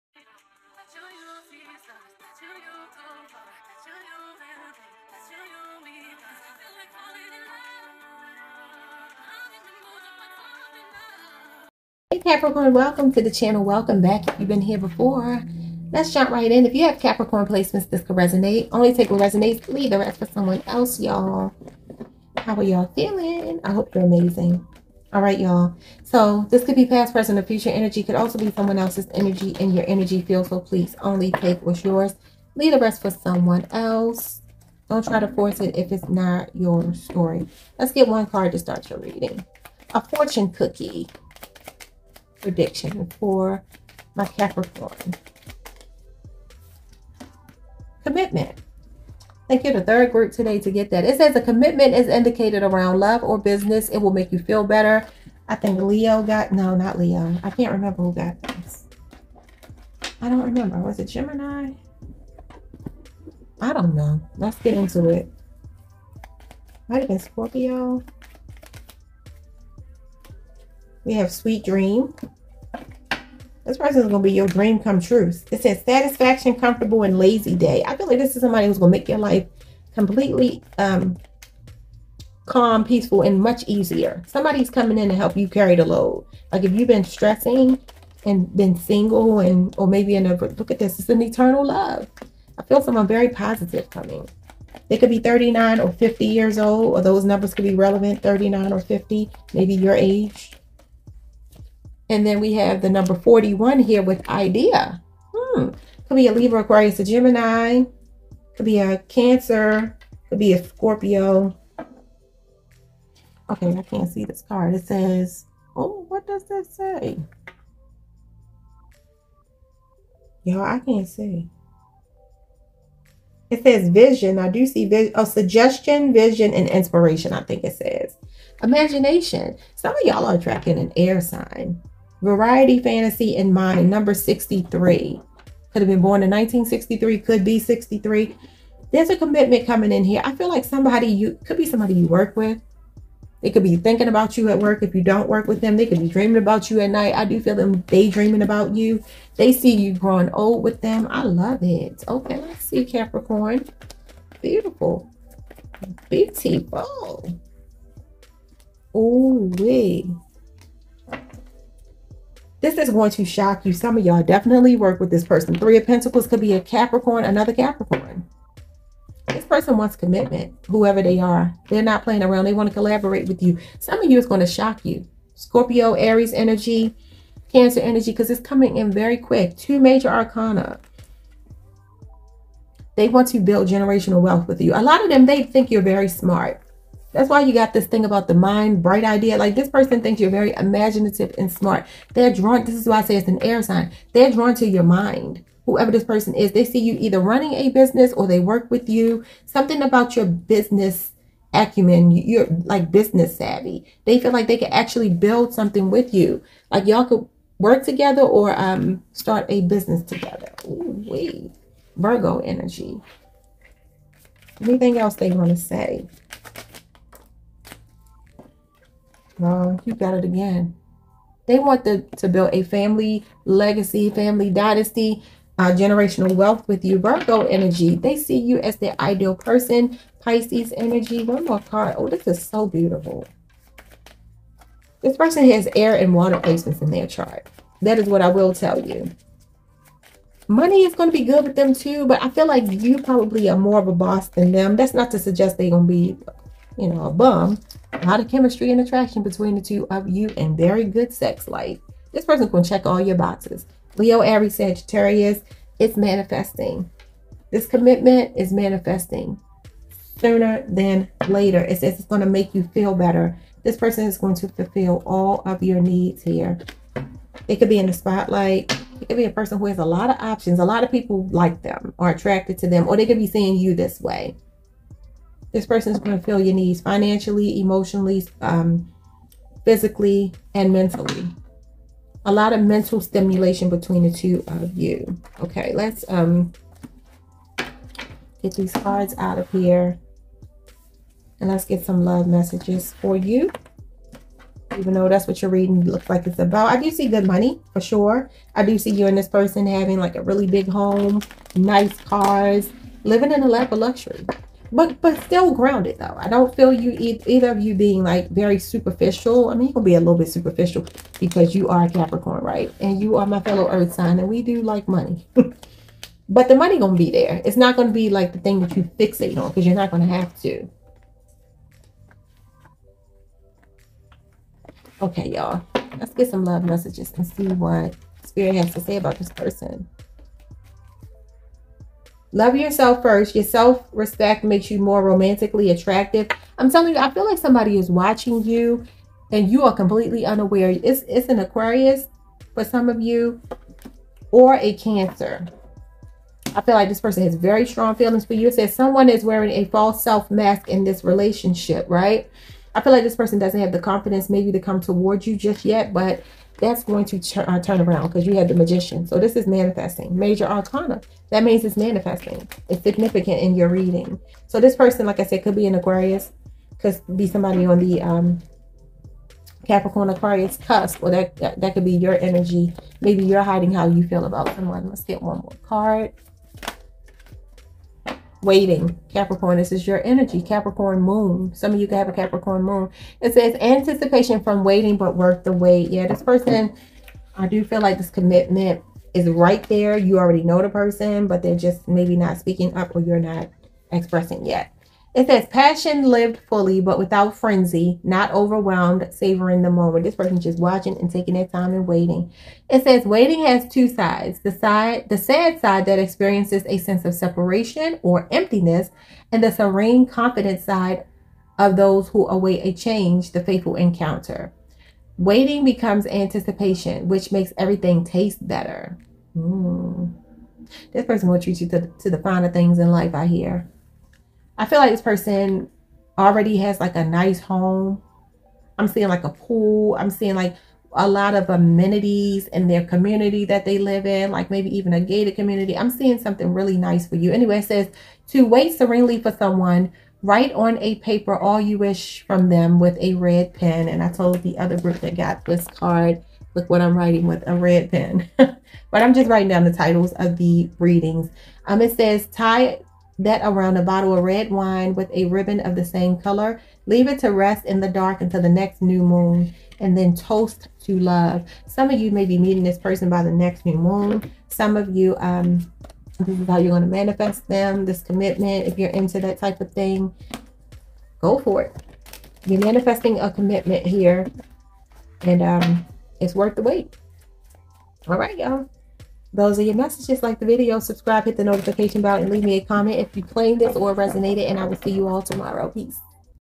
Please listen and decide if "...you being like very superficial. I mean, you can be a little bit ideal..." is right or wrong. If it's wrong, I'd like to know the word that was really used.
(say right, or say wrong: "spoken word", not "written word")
wrong: "superficial", not "ideal".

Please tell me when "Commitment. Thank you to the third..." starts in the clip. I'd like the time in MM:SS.
00:48.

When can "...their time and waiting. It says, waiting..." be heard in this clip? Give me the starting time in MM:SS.
06:41.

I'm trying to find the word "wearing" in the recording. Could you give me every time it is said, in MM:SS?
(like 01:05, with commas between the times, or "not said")
05:49.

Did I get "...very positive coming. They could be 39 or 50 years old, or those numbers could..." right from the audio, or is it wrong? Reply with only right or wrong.
right.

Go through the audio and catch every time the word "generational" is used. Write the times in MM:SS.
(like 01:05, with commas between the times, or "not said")
03:03, 03:45.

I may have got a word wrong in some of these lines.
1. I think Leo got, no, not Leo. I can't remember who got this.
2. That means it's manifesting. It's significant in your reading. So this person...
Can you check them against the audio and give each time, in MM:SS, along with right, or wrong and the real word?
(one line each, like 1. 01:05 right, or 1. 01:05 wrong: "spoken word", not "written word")
1. 00:55 right
2. 06:01 right.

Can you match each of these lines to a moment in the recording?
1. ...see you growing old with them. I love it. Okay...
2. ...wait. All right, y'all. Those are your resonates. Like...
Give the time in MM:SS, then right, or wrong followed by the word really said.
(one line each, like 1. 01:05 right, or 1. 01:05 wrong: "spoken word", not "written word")
1. 02:29 right
2. 07:56 wrong: "messages", not "resonates".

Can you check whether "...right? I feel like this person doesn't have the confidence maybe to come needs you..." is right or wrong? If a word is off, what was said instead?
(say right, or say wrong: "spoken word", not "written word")
wrong: "towards", not "needs".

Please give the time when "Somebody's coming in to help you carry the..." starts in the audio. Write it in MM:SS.
01:24.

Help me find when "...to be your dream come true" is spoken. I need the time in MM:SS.
01:14.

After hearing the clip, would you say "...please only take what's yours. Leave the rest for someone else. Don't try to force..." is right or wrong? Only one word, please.
right.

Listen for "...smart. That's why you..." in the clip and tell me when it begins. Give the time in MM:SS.
03:06.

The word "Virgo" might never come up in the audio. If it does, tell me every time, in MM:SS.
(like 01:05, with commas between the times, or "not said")
03:31, 03:46.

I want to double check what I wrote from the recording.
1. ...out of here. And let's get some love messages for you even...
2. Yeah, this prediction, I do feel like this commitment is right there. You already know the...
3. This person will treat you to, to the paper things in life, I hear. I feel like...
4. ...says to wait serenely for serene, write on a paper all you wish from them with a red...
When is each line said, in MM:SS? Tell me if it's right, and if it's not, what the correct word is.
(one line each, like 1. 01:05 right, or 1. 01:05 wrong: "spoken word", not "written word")
1. 04:49 right
2. 06:25 wrong: "person", not "prediction"
3. 07:00 wrong: "finer", not "paper"
4. 07:17 wrong: "someone", not "serene".